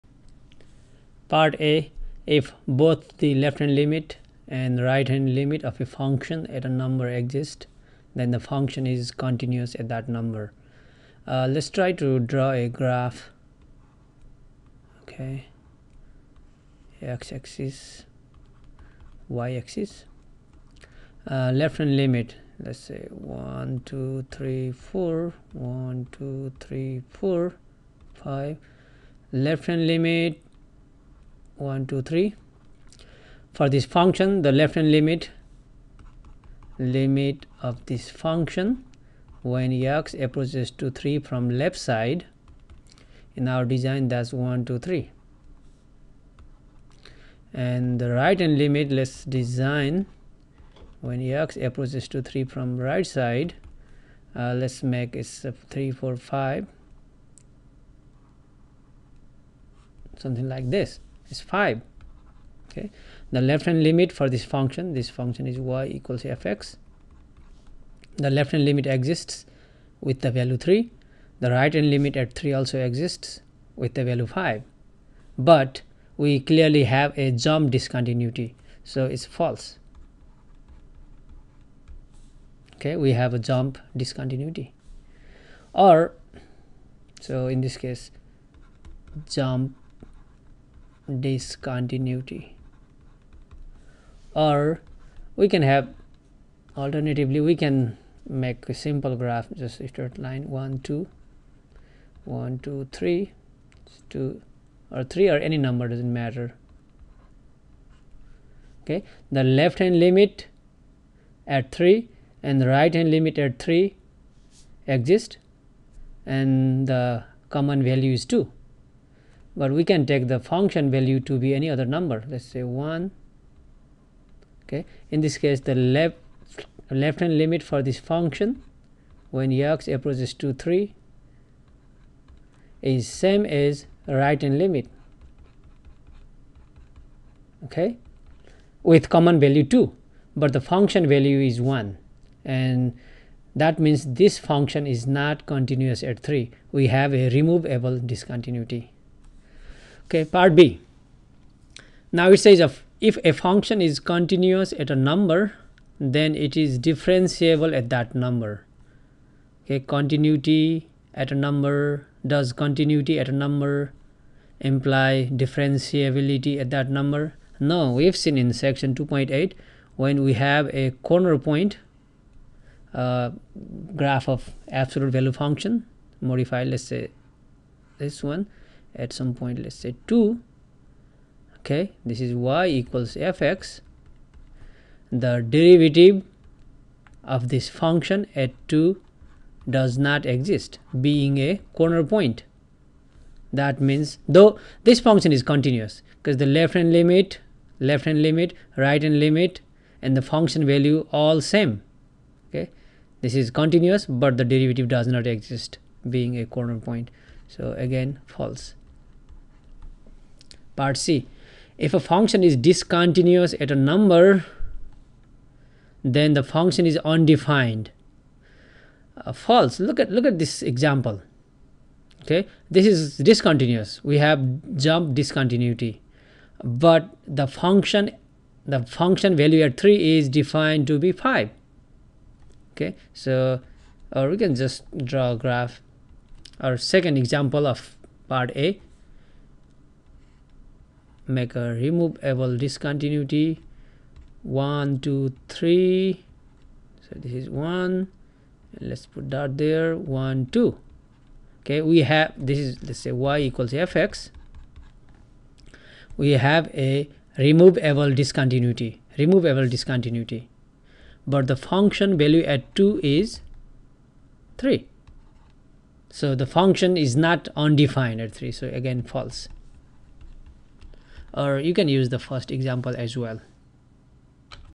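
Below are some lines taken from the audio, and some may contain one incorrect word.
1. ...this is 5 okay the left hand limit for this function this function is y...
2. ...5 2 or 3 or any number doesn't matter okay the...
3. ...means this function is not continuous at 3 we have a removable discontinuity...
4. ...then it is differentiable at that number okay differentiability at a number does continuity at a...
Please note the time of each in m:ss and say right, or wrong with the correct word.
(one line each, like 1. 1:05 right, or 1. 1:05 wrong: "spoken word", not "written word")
1. 1:00 right
2. 1:42 wrong: "3", not "5"
3. 2:23 right
4. 2:36 wrong: "continuity", not "differentiability".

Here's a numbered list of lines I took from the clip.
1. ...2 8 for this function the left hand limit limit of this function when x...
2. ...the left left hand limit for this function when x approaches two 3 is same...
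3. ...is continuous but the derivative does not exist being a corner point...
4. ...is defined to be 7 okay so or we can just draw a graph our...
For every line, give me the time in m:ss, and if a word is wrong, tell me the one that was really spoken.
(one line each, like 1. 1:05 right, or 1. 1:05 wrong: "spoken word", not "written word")
1. 0:31 wrong: "3", not "8"
2. 2:05 right
3. 3:23 right
4. 3:50 wrong: "5", not "7".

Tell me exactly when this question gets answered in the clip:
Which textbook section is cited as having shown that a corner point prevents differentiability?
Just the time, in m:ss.
2:48.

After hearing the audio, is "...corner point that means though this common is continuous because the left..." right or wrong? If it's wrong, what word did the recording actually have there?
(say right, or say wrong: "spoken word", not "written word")
wrong: "function", not "common".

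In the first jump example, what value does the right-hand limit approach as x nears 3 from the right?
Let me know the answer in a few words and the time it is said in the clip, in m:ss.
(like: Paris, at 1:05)
5, at 1:11.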